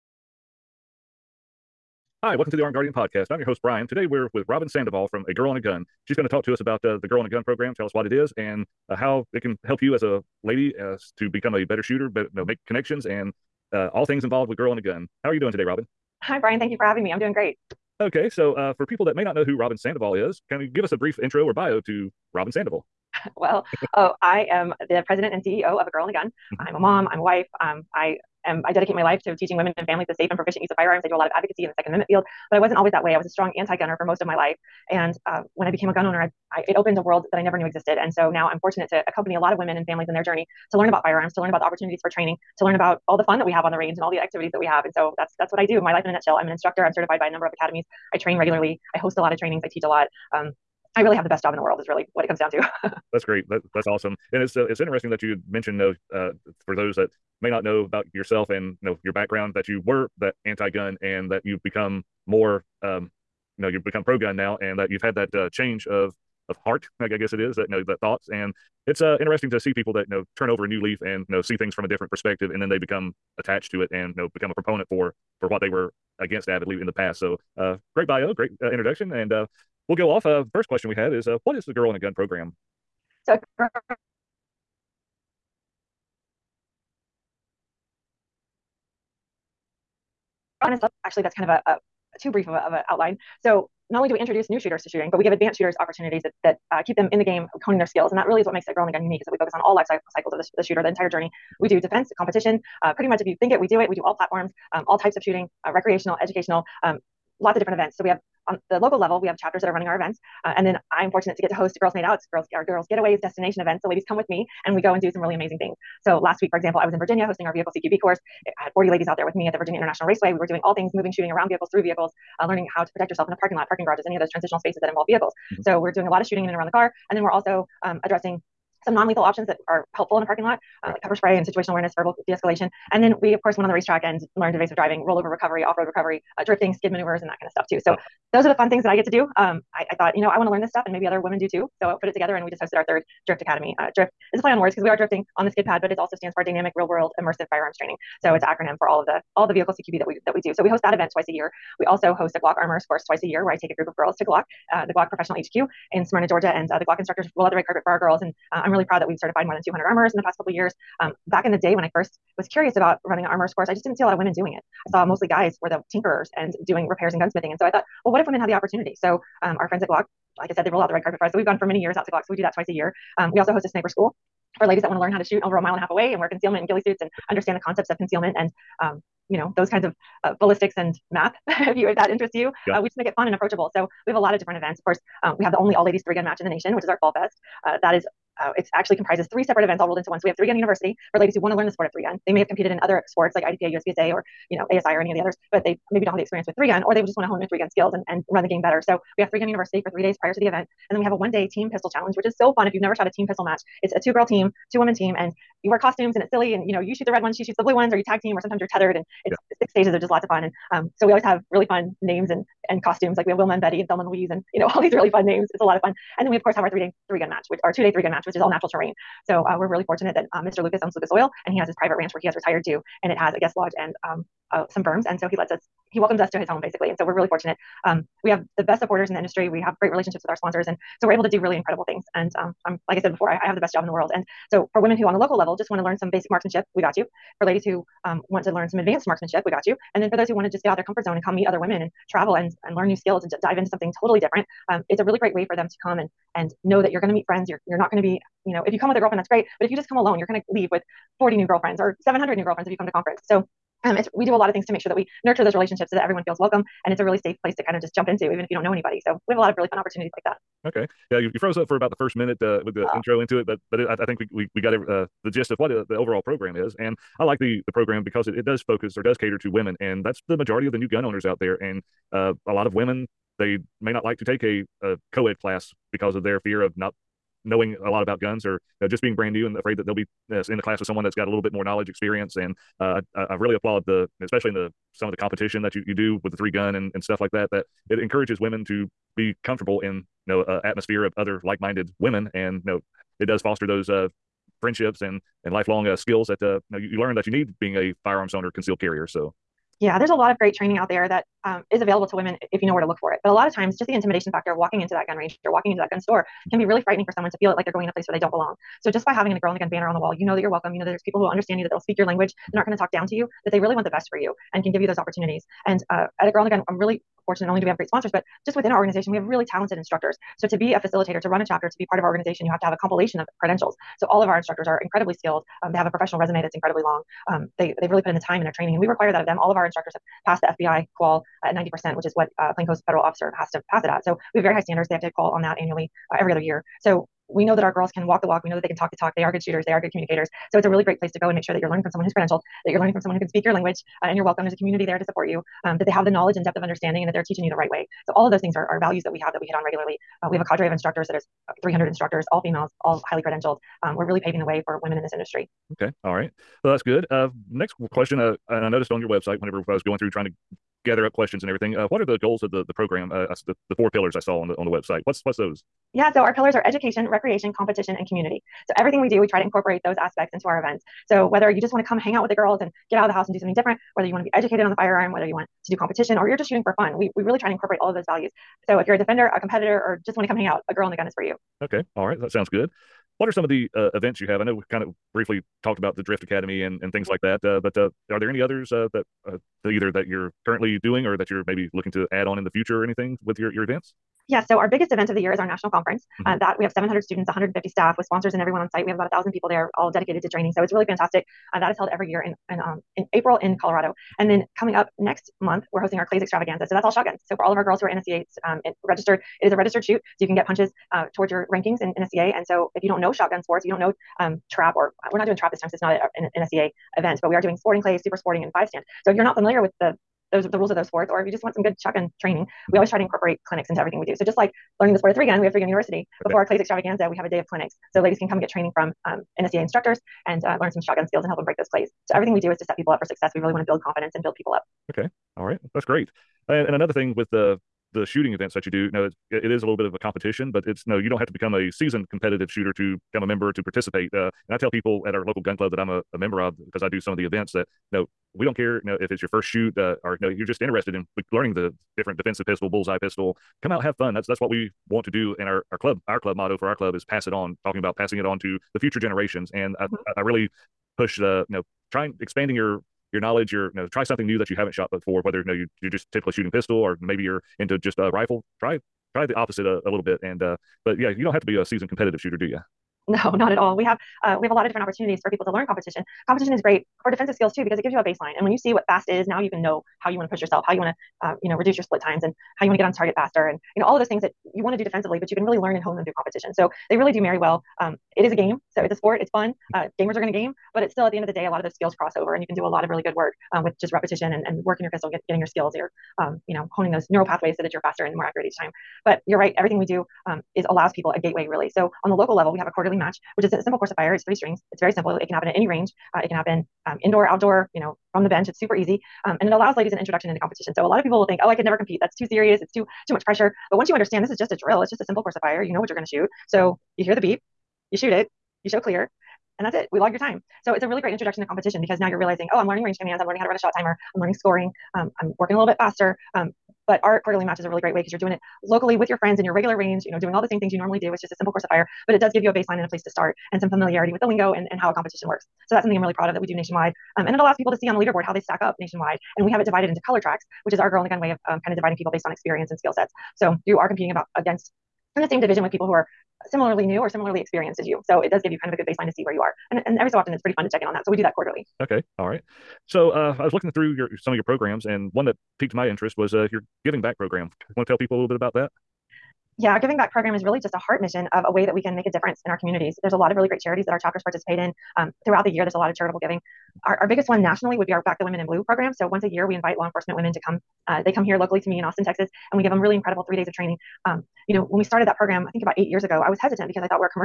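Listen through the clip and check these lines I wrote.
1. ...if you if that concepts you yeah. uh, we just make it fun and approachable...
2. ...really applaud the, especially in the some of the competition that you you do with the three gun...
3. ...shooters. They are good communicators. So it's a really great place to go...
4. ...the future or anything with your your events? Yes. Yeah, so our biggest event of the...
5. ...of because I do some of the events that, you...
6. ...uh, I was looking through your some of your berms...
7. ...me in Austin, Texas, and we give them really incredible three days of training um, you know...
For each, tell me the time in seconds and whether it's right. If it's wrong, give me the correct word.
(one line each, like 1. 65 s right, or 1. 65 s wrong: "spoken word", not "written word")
1. 181 s wrong: "interests", not "concepts"
2. 283 s right
3. 339 s right
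4. 392 s right
5. 446 s right
6. 553 s wrong: "programs", not "berms"
7. 571 s right.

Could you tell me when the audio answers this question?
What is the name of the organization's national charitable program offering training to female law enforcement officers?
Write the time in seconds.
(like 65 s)
568 s.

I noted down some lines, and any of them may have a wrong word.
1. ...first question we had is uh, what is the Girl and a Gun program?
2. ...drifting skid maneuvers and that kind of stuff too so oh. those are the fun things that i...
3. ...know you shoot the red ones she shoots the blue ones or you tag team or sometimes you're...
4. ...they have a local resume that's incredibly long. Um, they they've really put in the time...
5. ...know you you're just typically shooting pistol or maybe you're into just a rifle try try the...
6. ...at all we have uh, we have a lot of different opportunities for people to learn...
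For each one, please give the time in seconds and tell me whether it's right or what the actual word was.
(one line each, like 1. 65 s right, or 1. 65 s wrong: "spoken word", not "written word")
1. 80 s right
2. 136 s right
3. 206 s right
4. 325 s wrong: "professional", not "local"
5. 465 s right
6. 473 s right.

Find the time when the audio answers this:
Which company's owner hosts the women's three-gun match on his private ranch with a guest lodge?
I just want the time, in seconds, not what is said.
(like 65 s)
220 s.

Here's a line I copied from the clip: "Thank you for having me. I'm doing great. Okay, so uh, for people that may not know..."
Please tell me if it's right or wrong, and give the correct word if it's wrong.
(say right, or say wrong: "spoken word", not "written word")
right.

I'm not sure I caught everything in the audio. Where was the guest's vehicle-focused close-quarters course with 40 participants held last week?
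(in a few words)
Virginia International Raceway.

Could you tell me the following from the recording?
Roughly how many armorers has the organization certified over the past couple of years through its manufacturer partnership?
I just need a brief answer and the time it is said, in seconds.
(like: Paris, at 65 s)
More than 200, at 159 s.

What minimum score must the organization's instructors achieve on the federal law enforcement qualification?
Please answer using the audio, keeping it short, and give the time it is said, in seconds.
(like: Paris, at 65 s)
90%, at 331 s.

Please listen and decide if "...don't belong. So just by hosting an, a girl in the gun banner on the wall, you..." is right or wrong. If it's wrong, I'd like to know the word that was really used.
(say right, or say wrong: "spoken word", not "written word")
wrong: "having", not "hosting".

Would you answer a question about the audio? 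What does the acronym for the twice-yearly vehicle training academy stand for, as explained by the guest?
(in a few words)
Dynamic Real World Immersive Firearms Training.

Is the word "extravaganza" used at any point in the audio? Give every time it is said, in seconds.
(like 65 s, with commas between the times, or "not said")
406 s, 426 s.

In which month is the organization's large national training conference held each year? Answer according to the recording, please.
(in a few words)
April.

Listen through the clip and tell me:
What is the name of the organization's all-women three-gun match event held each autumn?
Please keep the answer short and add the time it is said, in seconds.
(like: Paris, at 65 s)
Fall Fest, at 187 s.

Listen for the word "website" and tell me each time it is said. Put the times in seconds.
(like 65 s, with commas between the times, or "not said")
359 s, 364 s.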